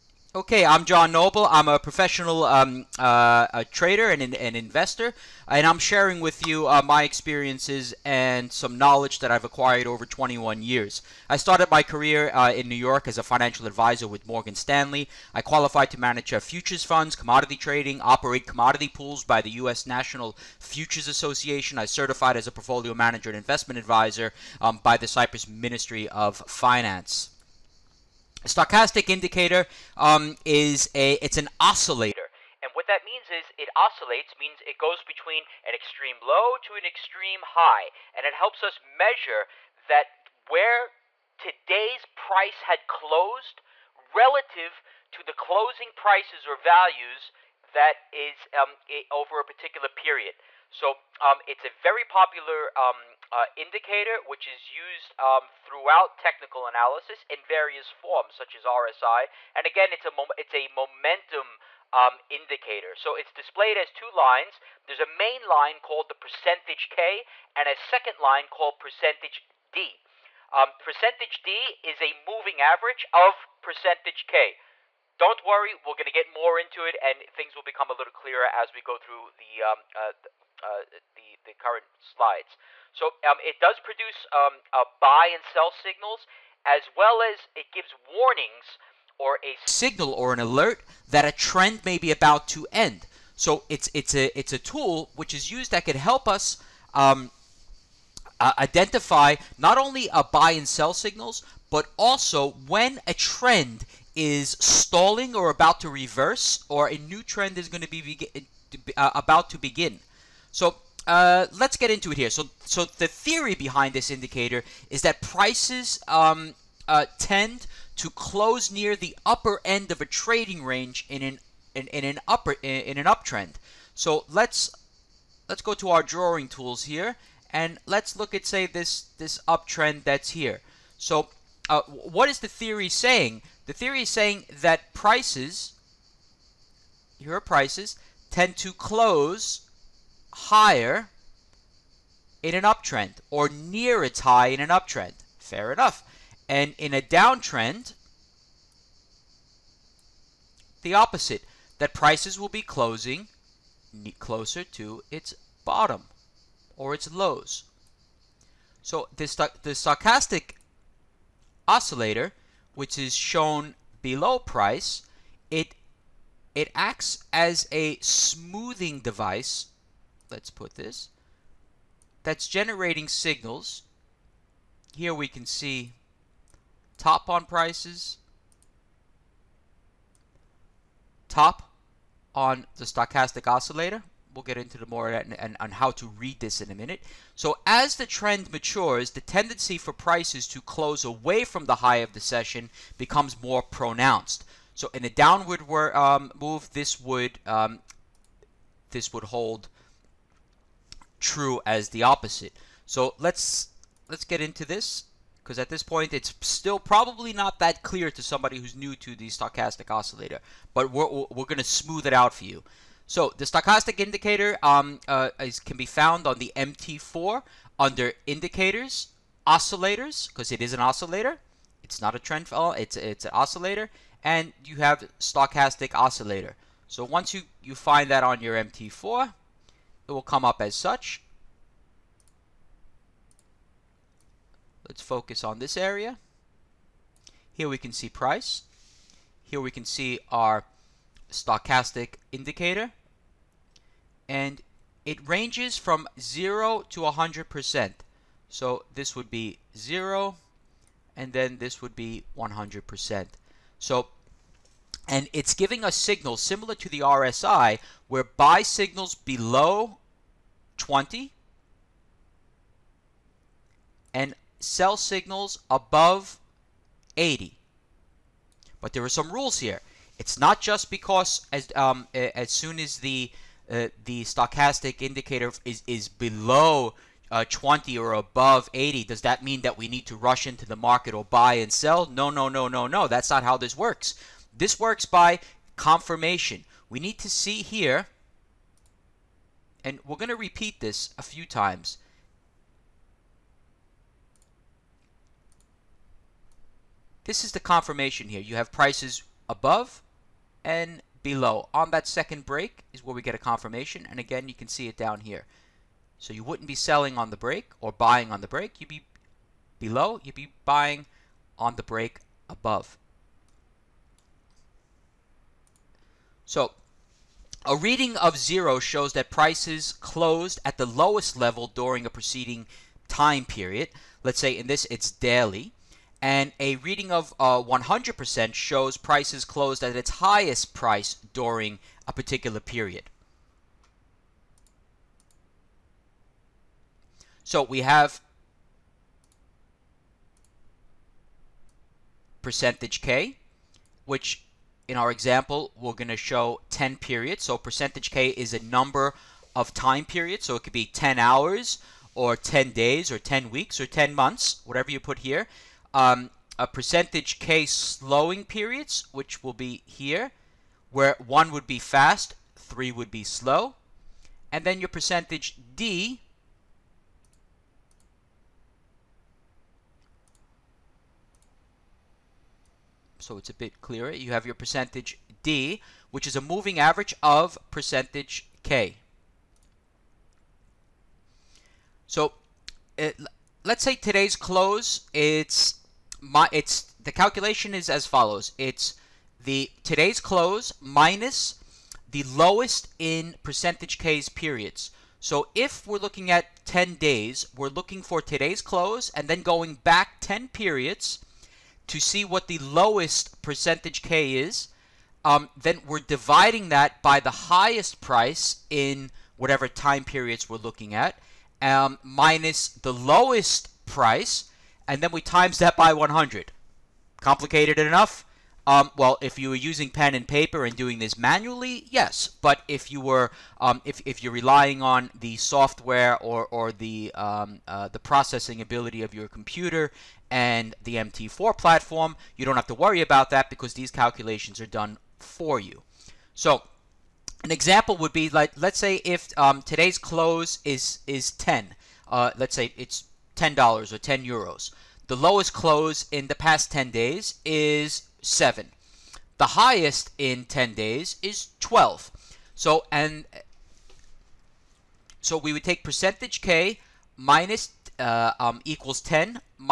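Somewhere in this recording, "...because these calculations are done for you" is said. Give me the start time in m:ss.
7:13.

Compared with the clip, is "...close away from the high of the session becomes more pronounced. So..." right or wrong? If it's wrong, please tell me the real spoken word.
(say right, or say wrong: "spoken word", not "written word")
right.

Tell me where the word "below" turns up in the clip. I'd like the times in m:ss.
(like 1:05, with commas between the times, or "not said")
2:44, 4:19, 4:36, 5:01, 5:09.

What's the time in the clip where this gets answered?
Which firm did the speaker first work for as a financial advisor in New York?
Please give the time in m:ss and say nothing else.
0:14.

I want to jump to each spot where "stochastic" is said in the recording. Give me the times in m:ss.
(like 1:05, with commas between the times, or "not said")
0:28, 2:39, 3:02, 3:29, 3:33, 3:45, 4:01, 4:34.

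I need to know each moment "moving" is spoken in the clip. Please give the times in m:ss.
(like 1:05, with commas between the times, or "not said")
1:12, 6:16.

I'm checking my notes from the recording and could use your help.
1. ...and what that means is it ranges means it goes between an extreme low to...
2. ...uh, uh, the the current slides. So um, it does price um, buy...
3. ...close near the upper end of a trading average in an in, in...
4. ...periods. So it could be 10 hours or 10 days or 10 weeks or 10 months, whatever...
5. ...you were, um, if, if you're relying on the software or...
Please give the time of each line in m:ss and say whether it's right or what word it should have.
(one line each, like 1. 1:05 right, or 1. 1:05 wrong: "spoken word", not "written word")
1. 0:32 wrong: "oscillates", not "ranges"
2. 1:19 wrong: "produce", not "price"
3. 1:58 wrong: "range", not "average"
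4. 5:50 right
5. 7:02 right.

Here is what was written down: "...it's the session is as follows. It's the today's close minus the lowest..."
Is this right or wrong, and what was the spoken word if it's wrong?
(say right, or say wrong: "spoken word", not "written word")
wrong: "calculation", not "session".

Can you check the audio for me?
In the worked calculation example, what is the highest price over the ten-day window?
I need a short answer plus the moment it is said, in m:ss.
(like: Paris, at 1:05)
12, at 7:31.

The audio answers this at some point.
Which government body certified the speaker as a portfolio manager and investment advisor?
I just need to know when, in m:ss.
0:25.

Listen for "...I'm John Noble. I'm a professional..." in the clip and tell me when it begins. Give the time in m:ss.
0:00.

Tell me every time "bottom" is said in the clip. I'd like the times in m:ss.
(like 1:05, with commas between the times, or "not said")
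2:35.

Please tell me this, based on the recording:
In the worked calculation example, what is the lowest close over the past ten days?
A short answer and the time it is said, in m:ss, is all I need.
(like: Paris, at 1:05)
7, at 7:28.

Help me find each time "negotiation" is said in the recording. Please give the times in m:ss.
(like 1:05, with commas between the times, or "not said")
not said.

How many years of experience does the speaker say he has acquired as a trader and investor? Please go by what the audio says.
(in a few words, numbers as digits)
21.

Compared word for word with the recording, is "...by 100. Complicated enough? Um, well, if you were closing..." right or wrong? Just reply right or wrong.
wrong.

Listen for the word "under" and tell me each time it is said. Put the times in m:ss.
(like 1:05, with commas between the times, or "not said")
3:37.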